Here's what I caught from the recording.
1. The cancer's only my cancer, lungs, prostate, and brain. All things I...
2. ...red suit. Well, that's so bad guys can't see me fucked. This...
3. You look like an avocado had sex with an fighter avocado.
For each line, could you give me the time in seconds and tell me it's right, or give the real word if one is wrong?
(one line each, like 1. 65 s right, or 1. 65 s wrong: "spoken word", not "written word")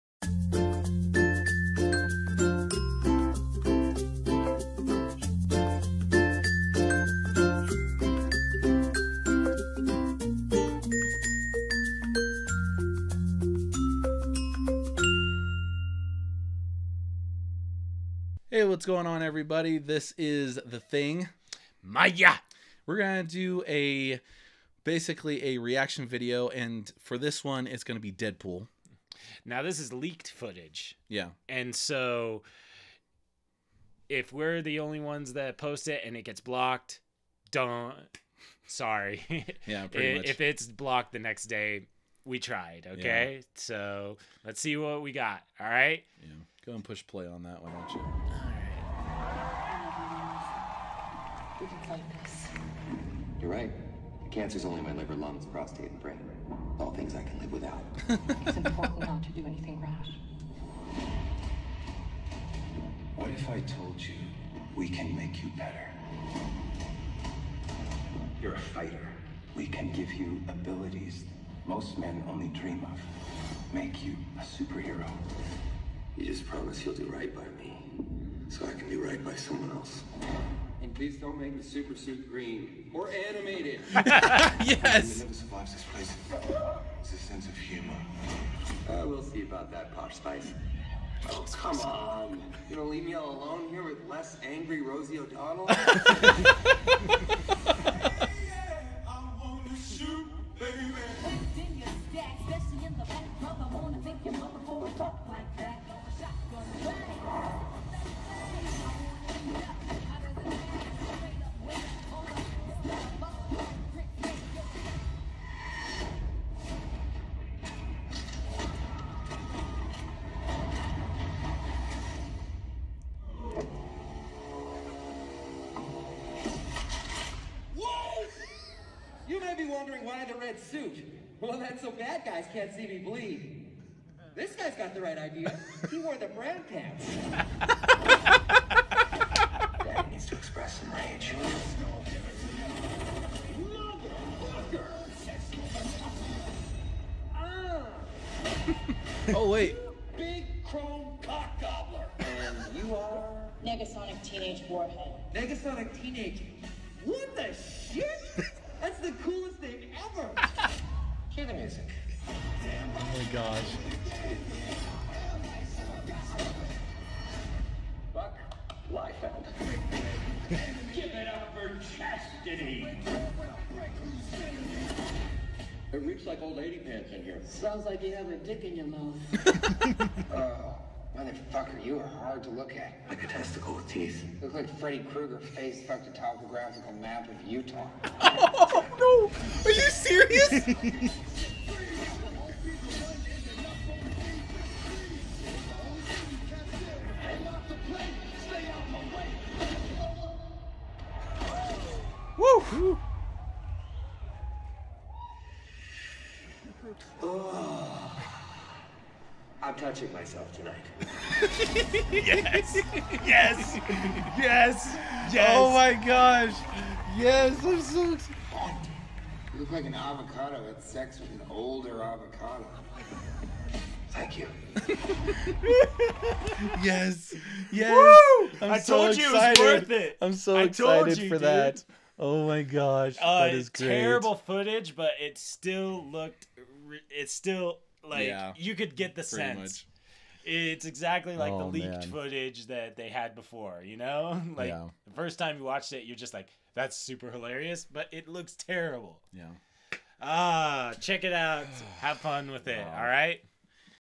1. 54 s wrong: "liver", not "cancer"
2. 130 s wrong: "bleed", not "fucked"
3. 219 s wrong: "older", not "fighter".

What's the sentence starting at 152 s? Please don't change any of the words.
And you are Negasonic Teenage Warhead.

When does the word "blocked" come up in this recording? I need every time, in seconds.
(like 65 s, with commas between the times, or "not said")
36 s, 40 s.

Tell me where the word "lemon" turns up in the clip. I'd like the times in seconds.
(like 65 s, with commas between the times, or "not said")
not said.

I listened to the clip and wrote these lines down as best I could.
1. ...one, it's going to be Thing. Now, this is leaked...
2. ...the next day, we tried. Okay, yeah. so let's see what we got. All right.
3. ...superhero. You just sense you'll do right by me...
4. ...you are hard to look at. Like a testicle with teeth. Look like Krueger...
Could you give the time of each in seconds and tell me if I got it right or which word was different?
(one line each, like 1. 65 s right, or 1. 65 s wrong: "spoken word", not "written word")
1. 27 s wrong: "Deadpool", not "Thing"
2. 41 s right
3. 74 s wrong: "promise", not "sense"
4. 181 s wrong: "Freddy", not "Krueger".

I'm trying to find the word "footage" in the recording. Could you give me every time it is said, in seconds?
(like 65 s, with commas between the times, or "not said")
30 s, 234 s, 242 s.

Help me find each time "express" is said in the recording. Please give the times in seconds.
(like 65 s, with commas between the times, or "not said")
140 s.